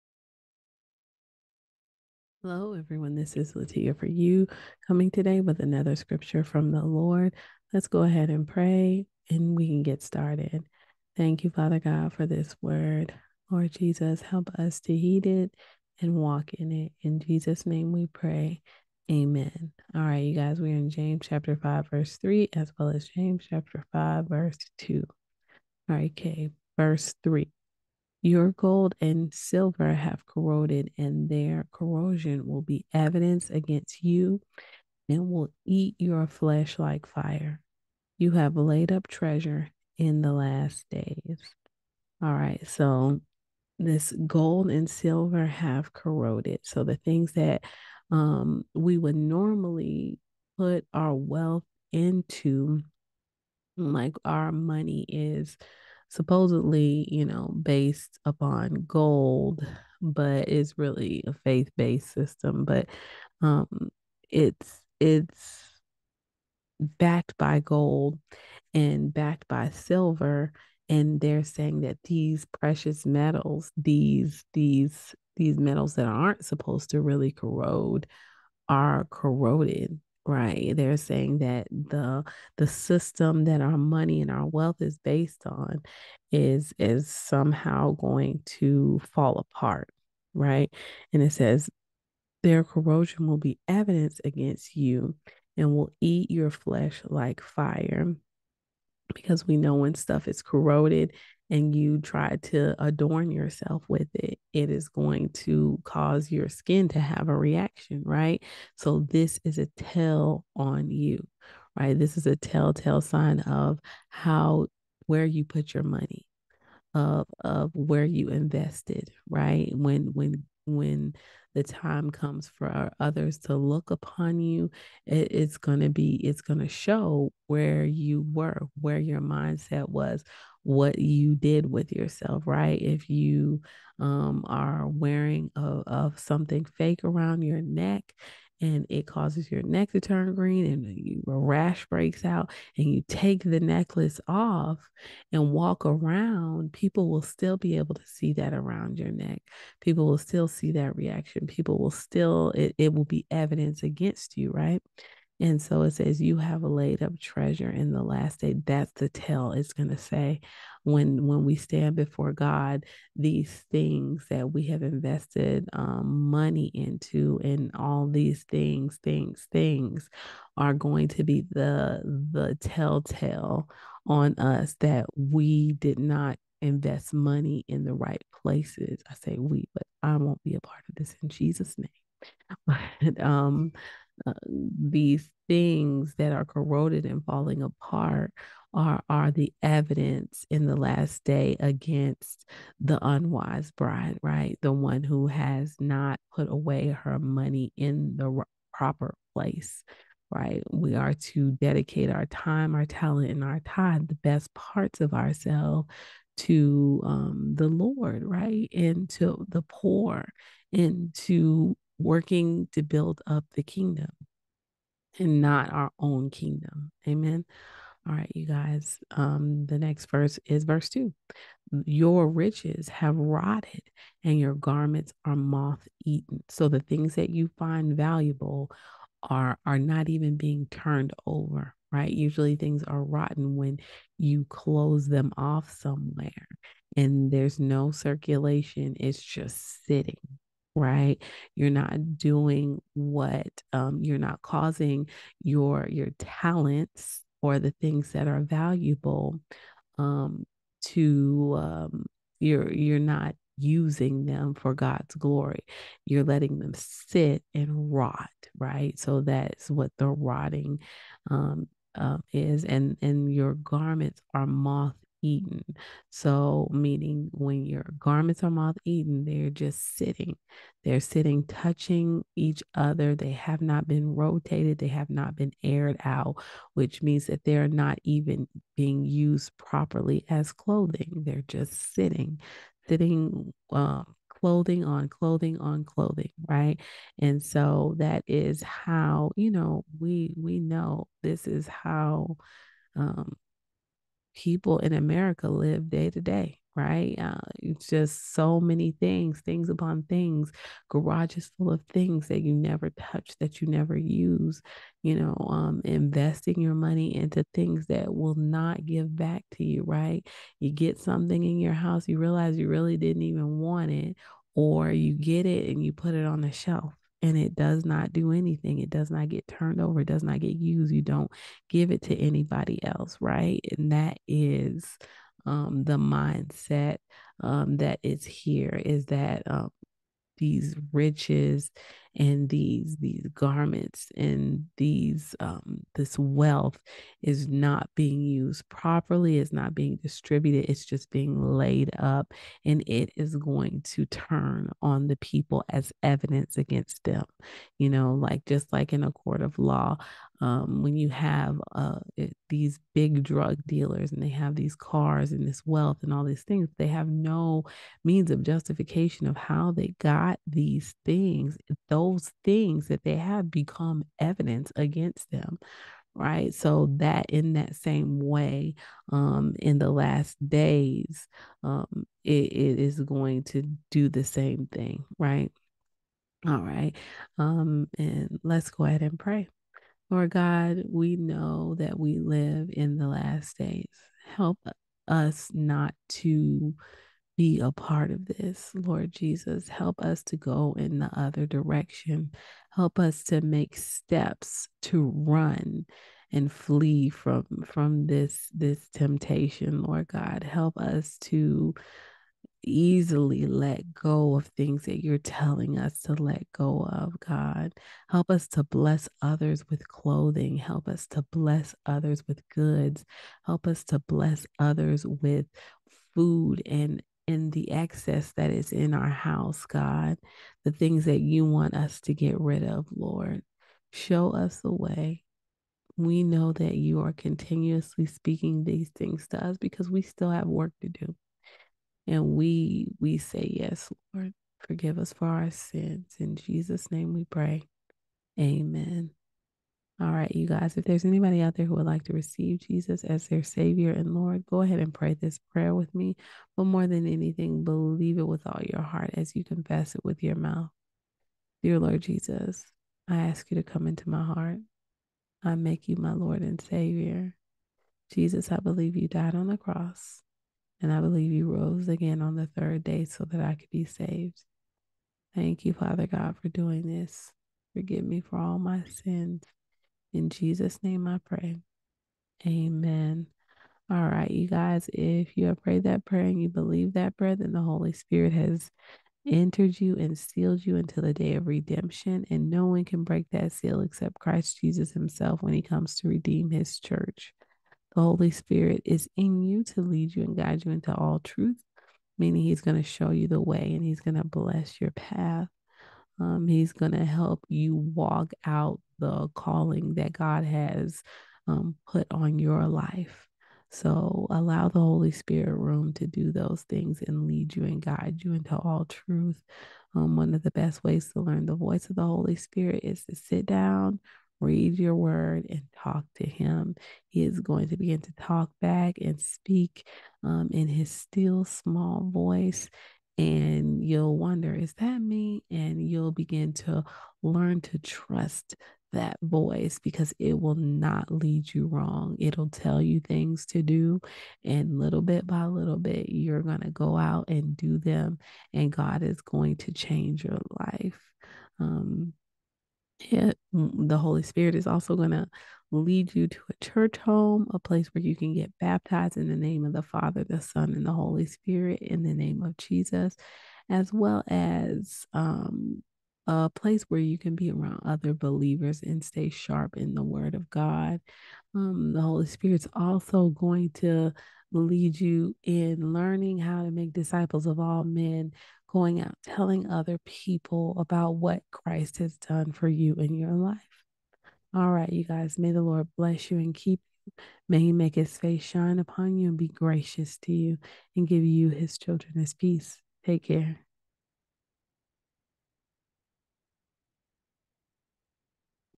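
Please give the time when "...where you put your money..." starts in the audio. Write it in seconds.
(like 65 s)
115 s.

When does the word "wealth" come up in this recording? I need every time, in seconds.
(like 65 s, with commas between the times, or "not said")
51 s, 84 s, 336 s, 355 s.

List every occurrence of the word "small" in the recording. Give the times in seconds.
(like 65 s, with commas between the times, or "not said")
521 s.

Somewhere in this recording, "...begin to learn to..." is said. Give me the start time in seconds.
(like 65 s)
526 s.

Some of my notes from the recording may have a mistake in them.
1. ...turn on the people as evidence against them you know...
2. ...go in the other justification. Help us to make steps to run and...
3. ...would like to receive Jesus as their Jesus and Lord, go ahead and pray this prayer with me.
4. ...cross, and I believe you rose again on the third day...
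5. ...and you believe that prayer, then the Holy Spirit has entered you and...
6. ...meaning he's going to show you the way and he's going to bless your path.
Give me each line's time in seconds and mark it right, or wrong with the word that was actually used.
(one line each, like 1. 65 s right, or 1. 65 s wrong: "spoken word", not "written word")
1. 344 s right
2. 390 s wrong: "direction", not "justification"
3. 441 s wrong: "Savior", not "Jesus"
4. 459 s right
5. 476 s right
6. 492 s right.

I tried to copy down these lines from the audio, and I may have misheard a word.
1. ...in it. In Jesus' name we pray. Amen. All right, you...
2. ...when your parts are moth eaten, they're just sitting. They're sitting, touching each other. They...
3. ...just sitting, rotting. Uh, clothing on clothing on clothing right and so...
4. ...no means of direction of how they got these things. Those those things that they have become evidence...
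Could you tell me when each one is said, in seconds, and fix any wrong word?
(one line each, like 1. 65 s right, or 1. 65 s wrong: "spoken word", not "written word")
1. 16 s right
2. 267 s wrong: "garments", not "parts"
3. 281 s wrong: "sitting", not "rotting"
4. 357 s wrong: "justification", not "direction".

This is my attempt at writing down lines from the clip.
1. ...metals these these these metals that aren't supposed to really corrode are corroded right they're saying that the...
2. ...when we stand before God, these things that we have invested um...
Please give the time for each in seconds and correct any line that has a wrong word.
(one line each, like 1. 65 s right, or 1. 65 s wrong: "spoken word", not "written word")
1. 73 s right
2. 161 s right.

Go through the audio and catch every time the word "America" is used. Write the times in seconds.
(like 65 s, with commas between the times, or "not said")
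294 s.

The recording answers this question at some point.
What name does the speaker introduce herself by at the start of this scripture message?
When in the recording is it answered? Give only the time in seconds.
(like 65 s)
3 s.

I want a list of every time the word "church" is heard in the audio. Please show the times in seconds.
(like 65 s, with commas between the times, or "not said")
486 s, 546 s.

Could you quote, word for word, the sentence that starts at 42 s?
All right, so this gold and silver have corroded.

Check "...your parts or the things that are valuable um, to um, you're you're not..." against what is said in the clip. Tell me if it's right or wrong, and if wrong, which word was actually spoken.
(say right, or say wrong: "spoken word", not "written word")
wrong: "talents", not "parts".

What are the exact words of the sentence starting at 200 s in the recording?
We are to dedicate our time, our talent, and our time, the best parts of ourselves to um, the Lord, right?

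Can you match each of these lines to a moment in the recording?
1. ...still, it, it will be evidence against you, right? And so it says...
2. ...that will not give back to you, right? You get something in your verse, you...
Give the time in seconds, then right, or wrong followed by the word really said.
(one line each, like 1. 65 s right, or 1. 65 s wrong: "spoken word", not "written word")
1. 151 s right
2. 307 s wrong: "house", not "verse".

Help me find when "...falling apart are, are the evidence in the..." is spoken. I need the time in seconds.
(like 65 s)
187 s.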